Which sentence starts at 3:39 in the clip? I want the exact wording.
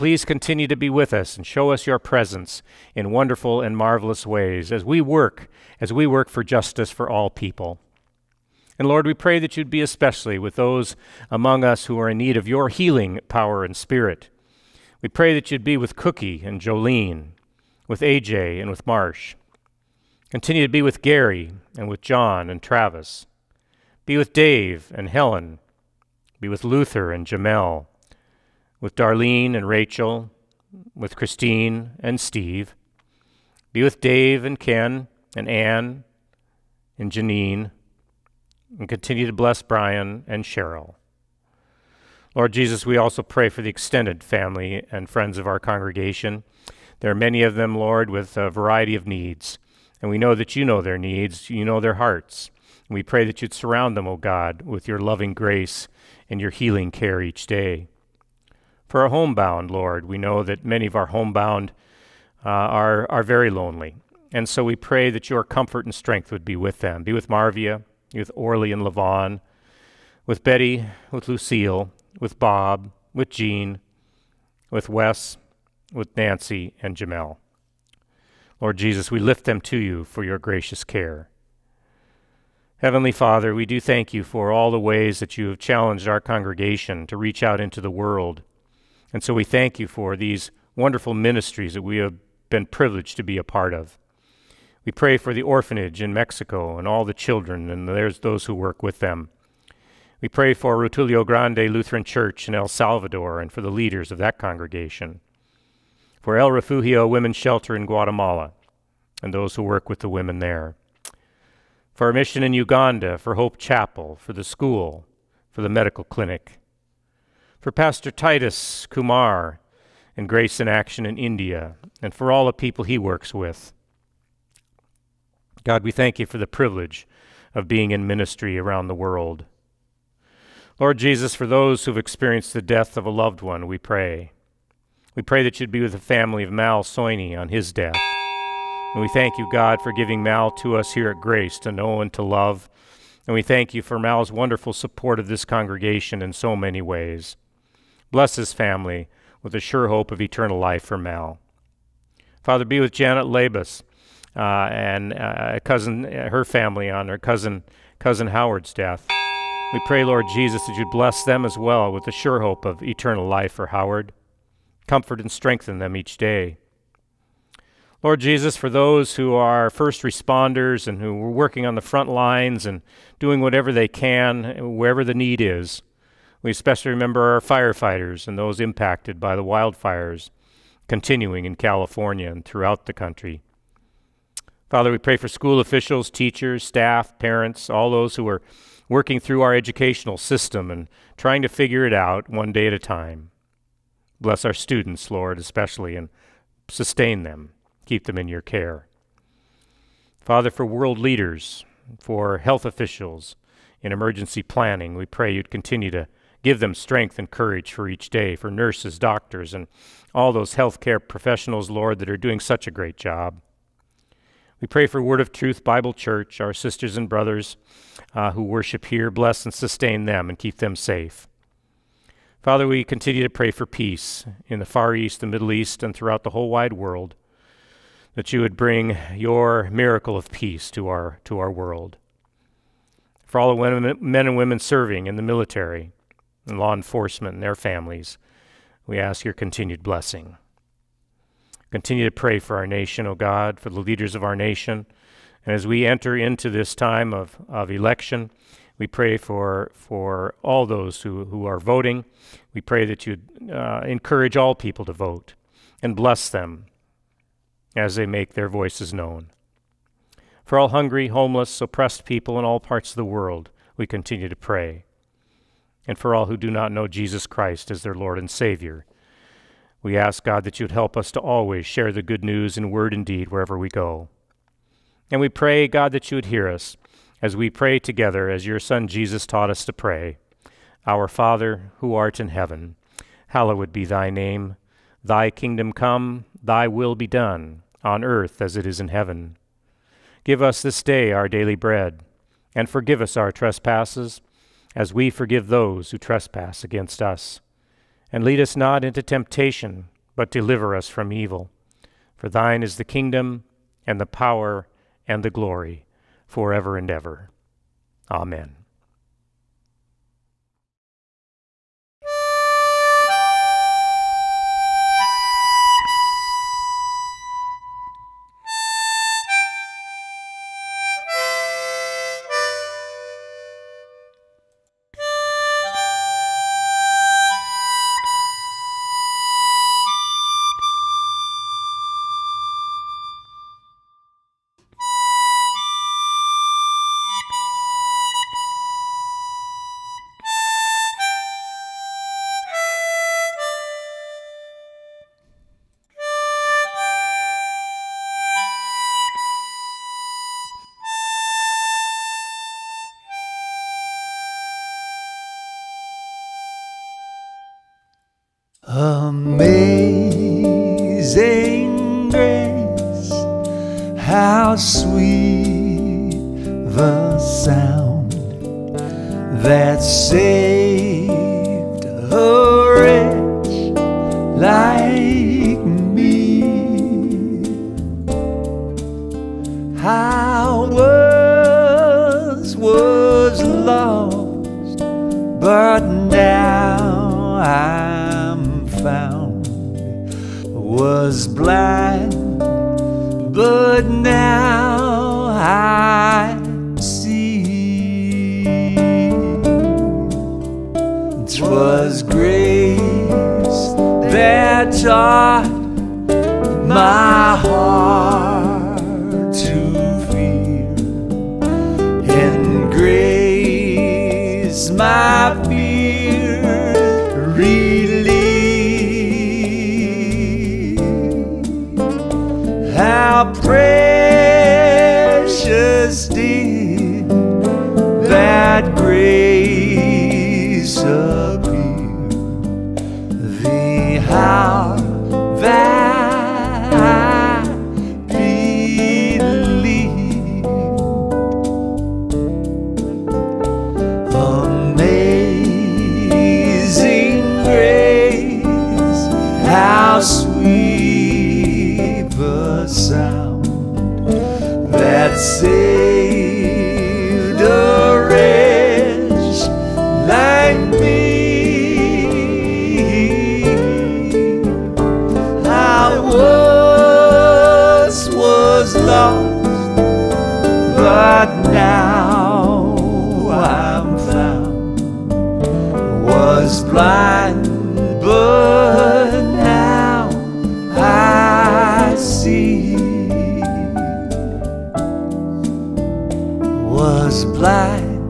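Bless and sustain them and keep them safe.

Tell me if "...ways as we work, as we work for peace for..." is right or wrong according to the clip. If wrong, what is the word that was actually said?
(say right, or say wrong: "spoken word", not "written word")
wrong: "justice", not "peace".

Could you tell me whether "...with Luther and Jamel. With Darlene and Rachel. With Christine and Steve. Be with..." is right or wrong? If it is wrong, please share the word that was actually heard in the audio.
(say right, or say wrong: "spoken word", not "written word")
right.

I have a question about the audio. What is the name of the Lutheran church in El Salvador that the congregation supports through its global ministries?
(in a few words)
Rutilio Grande Lutheran Church.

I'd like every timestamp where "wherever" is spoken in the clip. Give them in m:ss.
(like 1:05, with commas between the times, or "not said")
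2:54, 4:33.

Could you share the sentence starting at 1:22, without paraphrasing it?
Heavenly Father, we do thank you for all the ways that you have challenged our congregation to reach out into the world.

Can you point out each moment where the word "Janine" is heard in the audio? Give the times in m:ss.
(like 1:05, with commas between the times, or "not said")
0:37.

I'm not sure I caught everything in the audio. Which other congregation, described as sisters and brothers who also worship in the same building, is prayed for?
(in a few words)
Word of Truth Bible Church.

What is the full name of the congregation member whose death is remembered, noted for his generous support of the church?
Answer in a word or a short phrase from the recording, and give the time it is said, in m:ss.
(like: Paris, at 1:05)
Mal Soini, at 2:16.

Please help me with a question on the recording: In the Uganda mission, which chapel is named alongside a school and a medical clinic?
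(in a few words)
Hope Chapel.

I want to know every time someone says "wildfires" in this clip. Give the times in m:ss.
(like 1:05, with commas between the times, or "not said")
2:59.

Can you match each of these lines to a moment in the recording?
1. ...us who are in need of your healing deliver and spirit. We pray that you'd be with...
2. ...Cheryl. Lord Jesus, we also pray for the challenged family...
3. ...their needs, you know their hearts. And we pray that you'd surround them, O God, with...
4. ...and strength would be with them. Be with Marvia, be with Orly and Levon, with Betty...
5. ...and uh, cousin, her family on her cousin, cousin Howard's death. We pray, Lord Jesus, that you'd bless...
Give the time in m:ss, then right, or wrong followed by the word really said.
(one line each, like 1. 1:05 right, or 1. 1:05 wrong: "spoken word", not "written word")
1. 0:11 wrong: "power", not "deliver"
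2. 0:40 wrong: "extended", not "challenged"
3. 0:50 right
4. 1:05 right
5. 2:34 right.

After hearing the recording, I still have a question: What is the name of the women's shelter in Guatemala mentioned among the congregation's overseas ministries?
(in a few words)
El Refugio.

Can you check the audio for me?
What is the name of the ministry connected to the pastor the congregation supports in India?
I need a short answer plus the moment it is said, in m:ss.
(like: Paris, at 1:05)
Grace in Action, at 2:00.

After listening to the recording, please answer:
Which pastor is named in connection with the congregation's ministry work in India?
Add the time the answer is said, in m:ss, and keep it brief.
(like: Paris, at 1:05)
Titus Kumar, at 1:58.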